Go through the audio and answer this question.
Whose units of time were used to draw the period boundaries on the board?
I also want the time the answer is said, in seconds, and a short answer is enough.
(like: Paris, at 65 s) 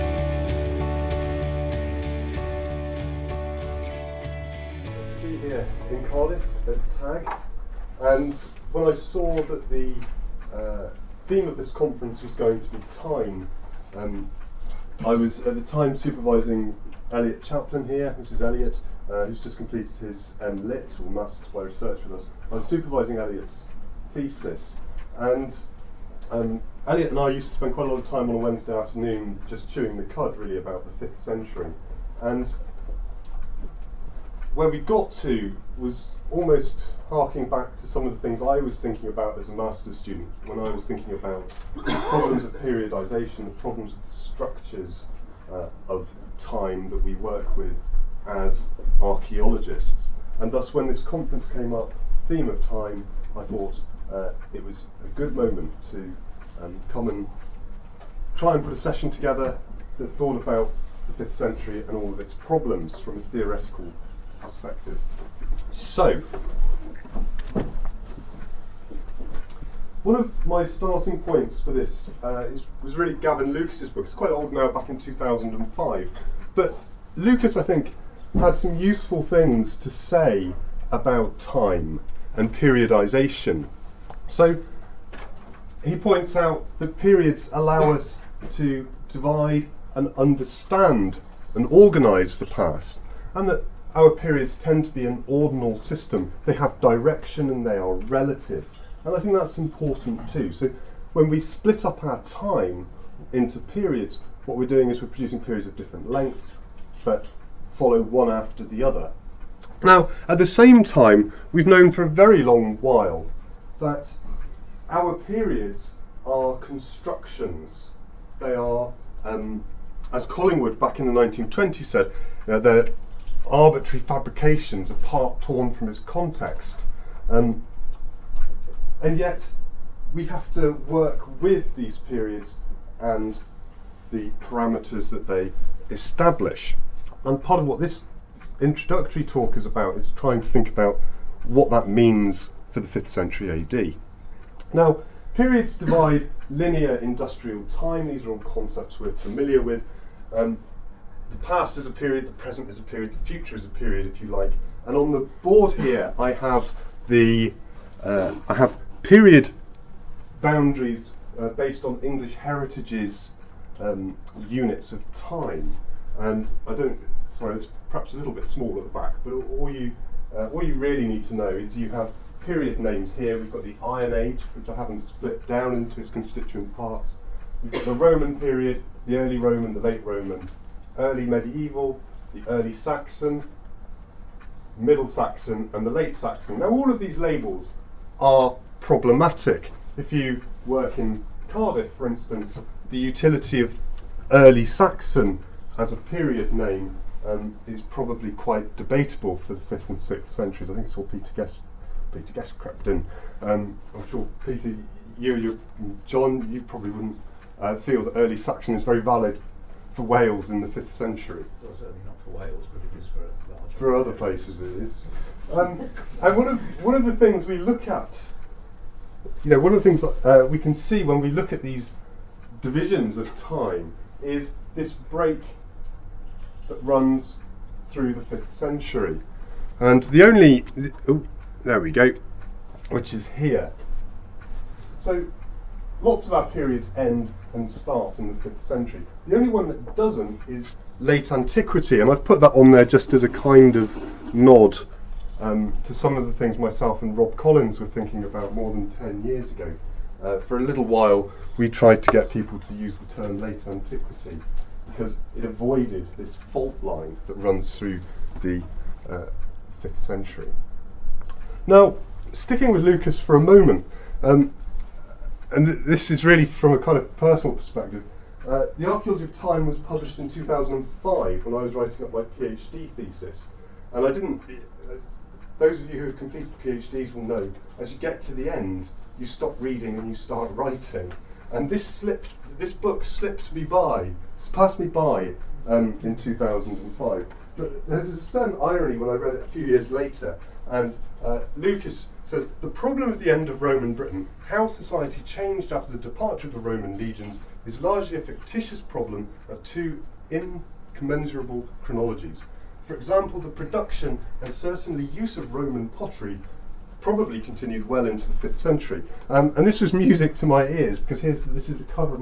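English Heritage, at 162 s.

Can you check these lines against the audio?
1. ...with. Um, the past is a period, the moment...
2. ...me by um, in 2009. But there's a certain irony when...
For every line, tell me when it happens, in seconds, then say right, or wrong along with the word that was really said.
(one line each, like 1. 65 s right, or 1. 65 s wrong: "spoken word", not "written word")
1. 149 s wrong: "present", not "moment"
2. 284 s wrong: "2005", not "2009".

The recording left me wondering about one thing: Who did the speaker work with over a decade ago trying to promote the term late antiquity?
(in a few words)
Rob Collins.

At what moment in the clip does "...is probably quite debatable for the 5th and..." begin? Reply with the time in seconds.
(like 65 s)
197 s.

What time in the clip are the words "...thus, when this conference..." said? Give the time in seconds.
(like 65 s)
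50 s.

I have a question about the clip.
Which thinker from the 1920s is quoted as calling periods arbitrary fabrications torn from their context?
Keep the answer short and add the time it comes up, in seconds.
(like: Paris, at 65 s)
Collingwood, at 120 s.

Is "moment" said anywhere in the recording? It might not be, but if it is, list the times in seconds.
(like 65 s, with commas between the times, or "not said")
55 s, 263 s.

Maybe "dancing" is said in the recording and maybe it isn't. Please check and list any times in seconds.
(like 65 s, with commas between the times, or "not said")
not said.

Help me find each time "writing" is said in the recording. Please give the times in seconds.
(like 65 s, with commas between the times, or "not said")
271 s, 280 s.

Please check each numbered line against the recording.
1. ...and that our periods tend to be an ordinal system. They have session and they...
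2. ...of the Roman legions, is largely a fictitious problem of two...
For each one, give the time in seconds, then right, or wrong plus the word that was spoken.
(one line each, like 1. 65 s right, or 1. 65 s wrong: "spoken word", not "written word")
1. 93 s wrong: "direction", not "session"
2. 296 s right.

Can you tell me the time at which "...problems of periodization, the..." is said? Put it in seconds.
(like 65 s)
42 s.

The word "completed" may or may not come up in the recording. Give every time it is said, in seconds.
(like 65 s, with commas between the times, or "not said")
19 s, 276 s.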